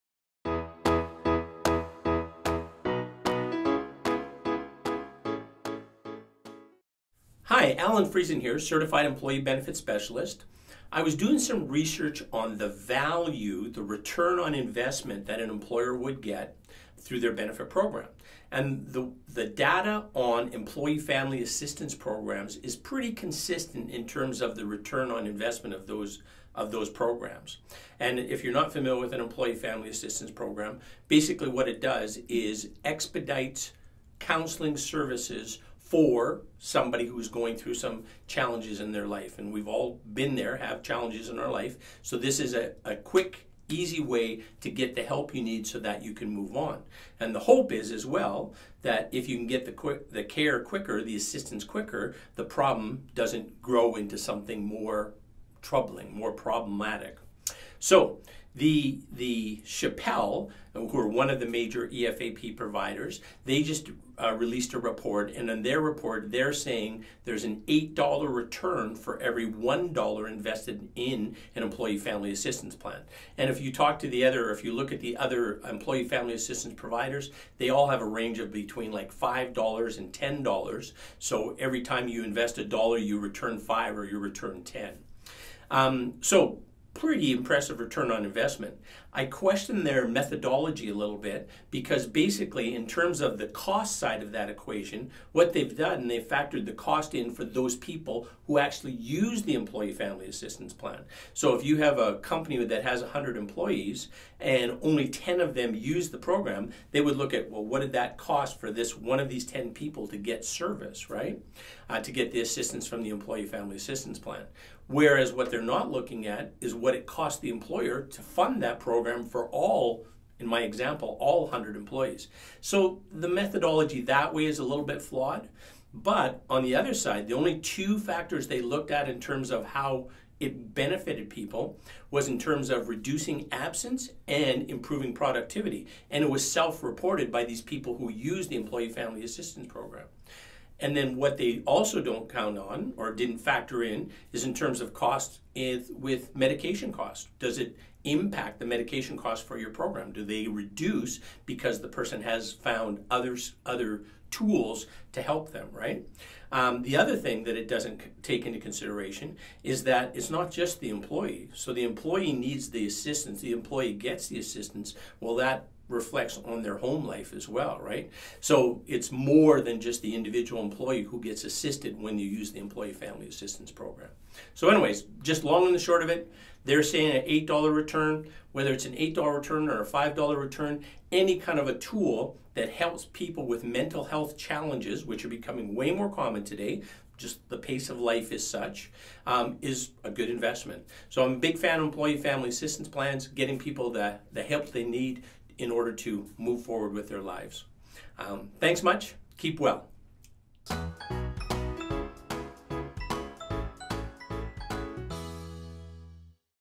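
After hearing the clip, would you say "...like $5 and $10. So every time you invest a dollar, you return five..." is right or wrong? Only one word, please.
right.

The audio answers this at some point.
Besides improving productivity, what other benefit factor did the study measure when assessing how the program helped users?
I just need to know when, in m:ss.
2:12.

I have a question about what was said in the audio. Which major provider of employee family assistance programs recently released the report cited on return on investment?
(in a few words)
Shepell.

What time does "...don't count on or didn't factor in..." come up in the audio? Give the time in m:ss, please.
2:22.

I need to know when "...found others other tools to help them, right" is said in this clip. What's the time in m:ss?
2:32.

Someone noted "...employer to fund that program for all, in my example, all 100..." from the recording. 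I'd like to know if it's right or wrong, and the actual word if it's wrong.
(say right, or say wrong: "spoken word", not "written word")
right.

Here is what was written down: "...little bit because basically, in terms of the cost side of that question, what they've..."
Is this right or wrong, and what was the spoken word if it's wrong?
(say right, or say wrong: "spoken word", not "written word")
wrong: "equation", not "question".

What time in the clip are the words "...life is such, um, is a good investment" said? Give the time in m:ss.
3:07.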